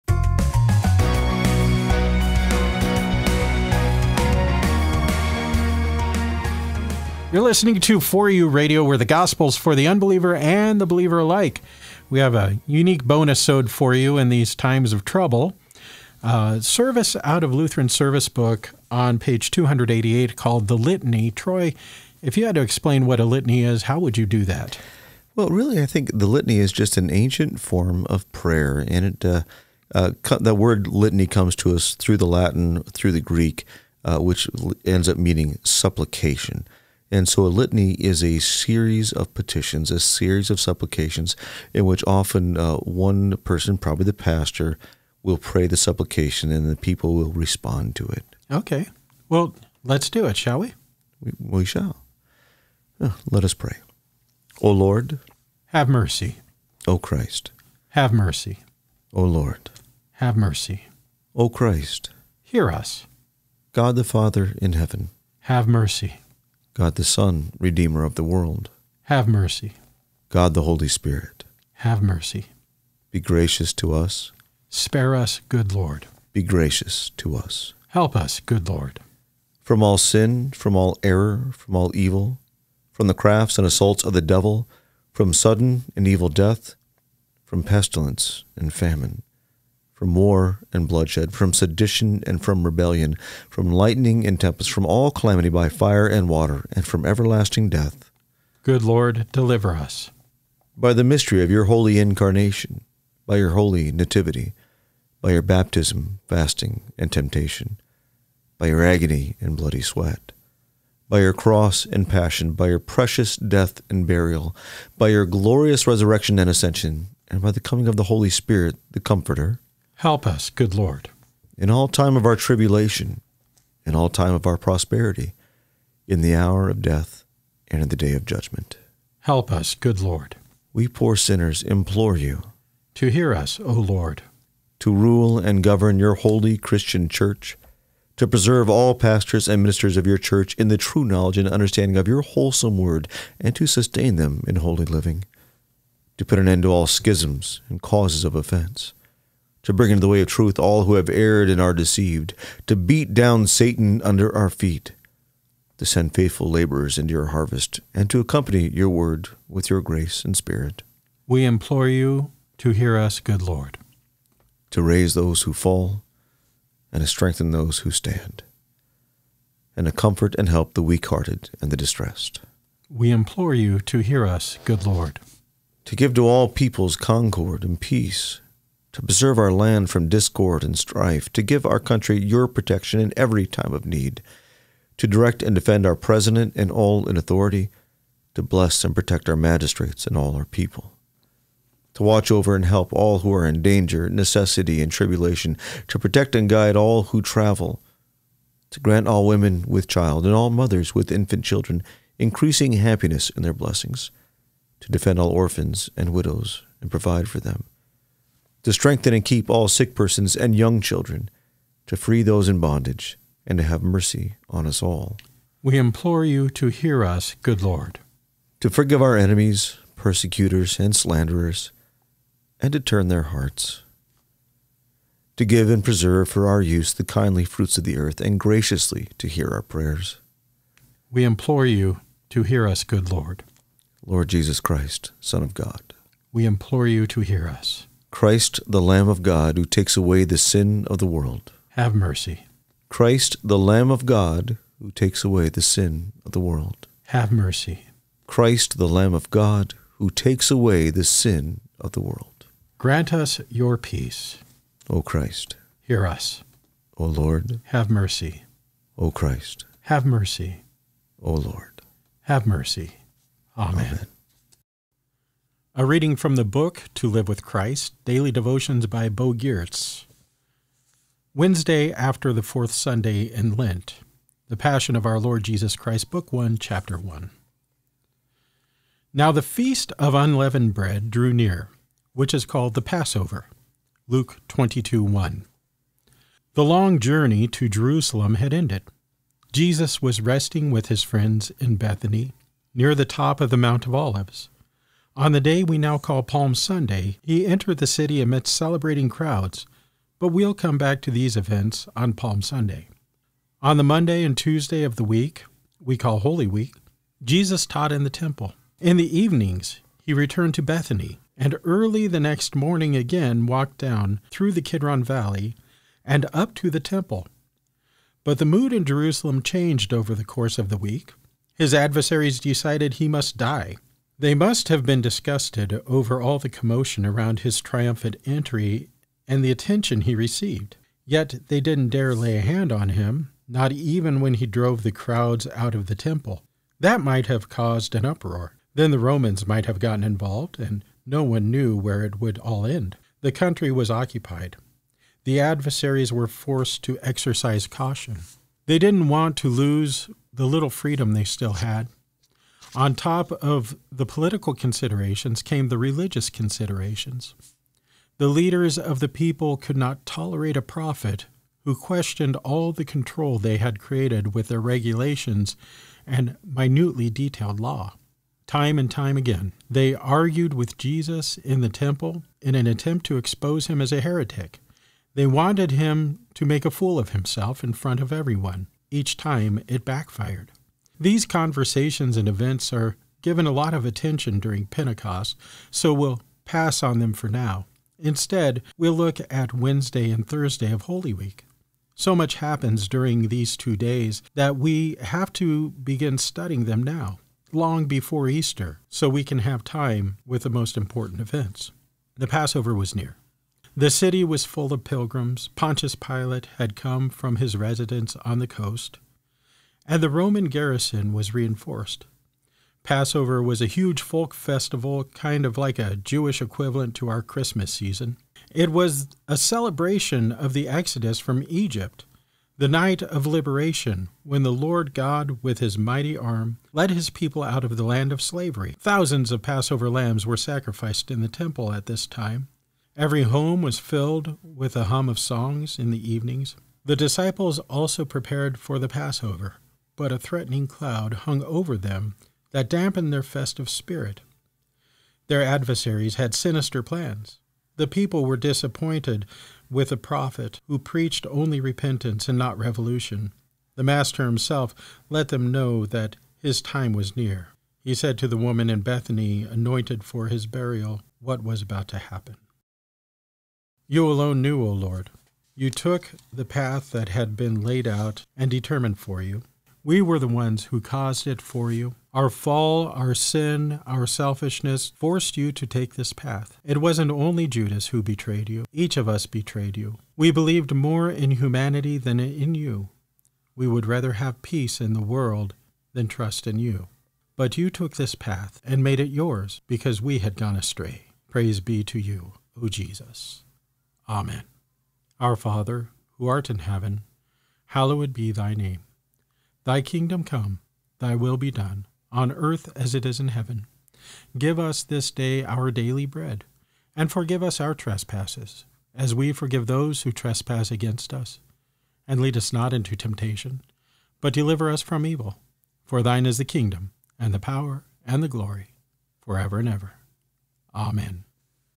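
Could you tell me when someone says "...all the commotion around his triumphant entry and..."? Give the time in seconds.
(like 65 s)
326 s.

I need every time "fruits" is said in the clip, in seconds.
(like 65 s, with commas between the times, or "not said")
227 s.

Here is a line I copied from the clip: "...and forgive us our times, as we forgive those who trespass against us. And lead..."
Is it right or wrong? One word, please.
wrong.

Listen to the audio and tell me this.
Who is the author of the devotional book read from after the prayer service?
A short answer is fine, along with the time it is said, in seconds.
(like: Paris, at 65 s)
Bo Giertz, at 269 s.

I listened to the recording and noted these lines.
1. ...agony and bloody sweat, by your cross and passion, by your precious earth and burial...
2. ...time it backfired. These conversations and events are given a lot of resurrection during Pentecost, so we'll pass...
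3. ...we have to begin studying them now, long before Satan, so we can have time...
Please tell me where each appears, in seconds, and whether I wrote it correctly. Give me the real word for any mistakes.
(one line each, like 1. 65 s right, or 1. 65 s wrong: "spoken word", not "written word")
1. 108 s wrong: "death", not "earth"
2. 379 s wrong: "attention", not "resurrection"
3. 394 s wrong: "Easter", not "Satan".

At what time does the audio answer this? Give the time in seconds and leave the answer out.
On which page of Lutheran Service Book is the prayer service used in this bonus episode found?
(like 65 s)
19 s.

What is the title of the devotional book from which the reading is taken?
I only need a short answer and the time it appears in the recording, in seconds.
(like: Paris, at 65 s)
To Live with Christ, at 266 s.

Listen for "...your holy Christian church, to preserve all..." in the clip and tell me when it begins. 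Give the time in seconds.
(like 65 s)
135 s.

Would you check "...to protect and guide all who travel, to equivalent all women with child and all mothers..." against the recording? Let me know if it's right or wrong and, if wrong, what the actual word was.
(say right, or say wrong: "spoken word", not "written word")
wrong: "grant", not "equivalent".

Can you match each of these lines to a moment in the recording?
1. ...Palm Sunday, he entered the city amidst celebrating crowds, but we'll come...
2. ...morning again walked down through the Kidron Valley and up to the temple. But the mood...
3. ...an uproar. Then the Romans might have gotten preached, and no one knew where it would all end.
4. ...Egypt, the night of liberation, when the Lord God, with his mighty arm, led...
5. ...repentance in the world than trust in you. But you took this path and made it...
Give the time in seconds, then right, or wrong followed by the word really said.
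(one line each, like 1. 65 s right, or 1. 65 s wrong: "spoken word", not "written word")
1. 296 s right
2. 312 s right
3. 337 s wrong: "involved", not "preached"
4. 421 s right
5. 484 s wrong: "peace", not "repentance".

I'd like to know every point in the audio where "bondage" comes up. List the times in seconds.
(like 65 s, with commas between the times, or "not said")
212 s.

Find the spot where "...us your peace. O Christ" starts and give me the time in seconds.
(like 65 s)
253 s.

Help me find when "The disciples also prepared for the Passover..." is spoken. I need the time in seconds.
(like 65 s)
436 s.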